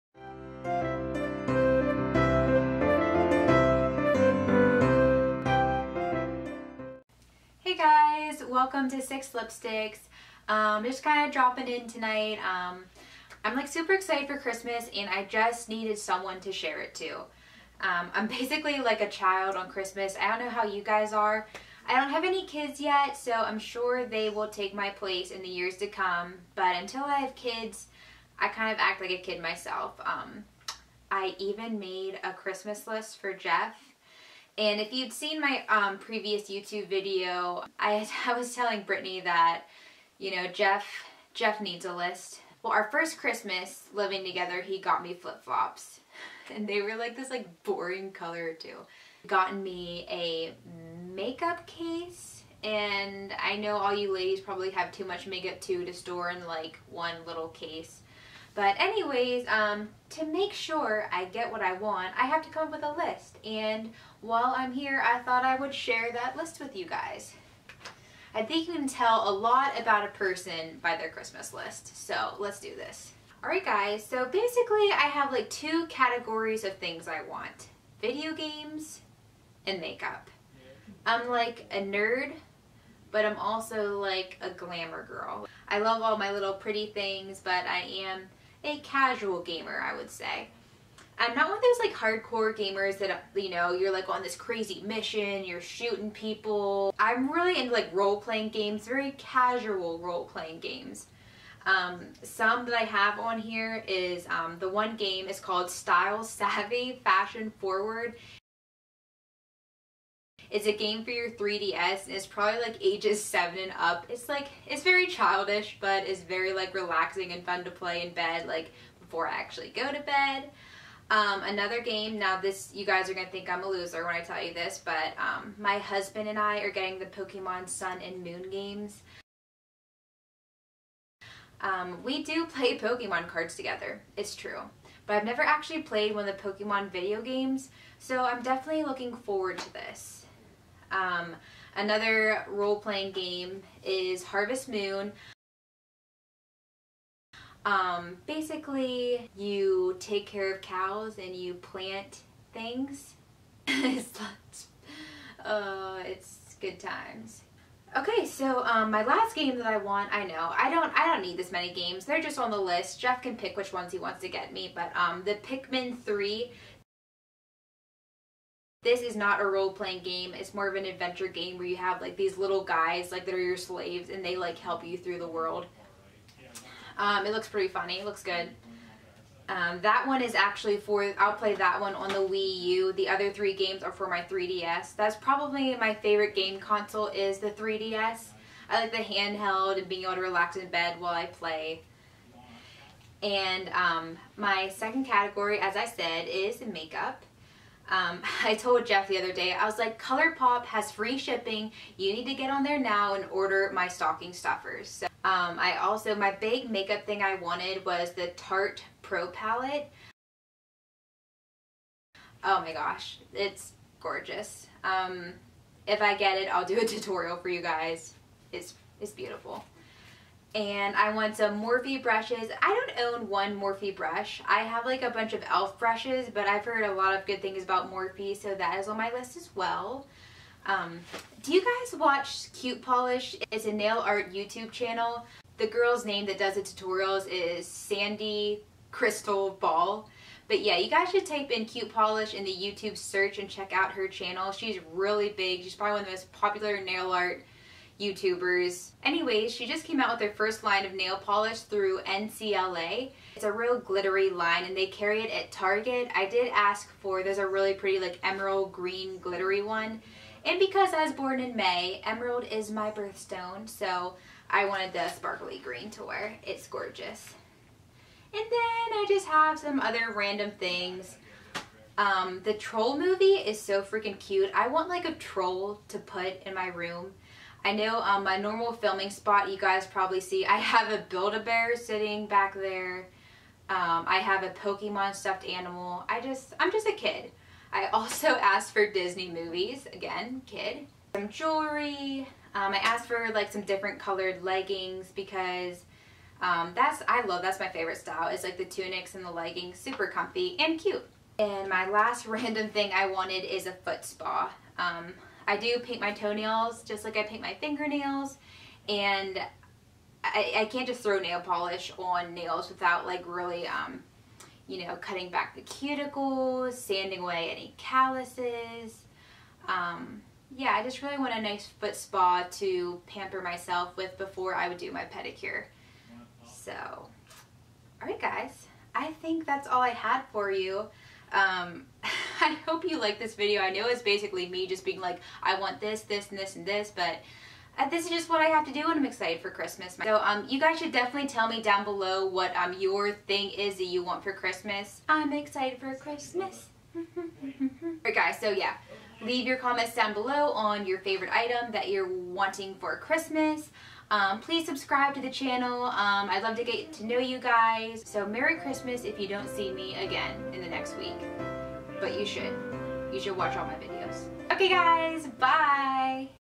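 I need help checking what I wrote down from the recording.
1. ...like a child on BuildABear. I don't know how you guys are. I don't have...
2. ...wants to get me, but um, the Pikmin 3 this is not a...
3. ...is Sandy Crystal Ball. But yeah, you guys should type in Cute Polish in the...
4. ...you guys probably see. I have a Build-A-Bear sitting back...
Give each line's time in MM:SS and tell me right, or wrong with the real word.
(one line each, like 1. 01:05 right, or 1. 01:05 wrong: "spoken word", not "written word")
1. 00:18 wrong: "Christmas", not "BuildABear"
2. 02:43 right
3. 03:57 right
4. 04:39 right.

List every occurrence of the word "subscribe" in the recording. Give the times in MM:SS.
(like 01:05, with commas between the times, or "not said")
05:54.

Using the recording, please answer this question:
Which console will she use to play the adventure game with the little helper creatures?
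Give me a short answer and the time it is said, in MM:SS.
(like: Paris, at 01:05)
Wii U, at 03:02.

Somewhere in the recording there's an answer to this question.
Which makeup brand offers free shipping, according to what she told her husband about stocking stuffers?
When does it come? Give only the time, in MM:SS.
03:20.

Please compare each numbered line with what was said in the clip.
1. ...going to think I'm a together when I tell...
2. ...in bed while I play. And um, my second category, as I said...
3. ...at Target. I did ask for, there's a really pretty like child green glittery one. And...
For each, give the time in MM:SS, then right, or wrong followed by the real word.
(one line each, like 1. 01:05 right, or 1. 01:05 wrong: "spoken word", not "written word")
1. 02:03 wrong: "loser", not "together"
2. 03:10 right
3. 04:15 wrong: "emerald", not "child".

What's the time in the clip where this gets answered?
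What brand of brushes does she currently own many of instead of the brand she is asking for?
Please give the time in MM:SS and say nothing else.
03:45.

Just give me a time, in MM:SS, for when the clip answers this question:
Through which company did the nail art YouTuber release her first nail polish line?
04:12.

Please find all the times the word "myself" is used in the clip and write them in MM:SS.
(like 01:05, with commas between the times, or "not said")
00:29, 05:23.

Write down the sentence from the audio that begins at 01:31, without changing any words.
I'm not one of those like hardcore gamers that you know you're like on this crazy mission, you're shooting people.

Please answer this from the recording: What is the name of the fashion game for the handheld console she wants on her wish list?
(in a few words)
Style Savvy Fashion Forward.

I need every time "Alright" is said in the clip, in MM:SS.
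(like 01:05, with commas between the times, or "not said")
01:13, 05:46.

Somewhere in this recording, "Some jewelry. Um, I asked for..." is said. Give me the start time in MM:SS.
04:51.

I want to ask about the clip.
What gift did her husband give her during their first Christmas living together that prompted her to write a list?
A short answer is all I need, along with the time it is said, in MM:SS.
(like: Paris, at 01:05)
Flip-flops, at 00:45.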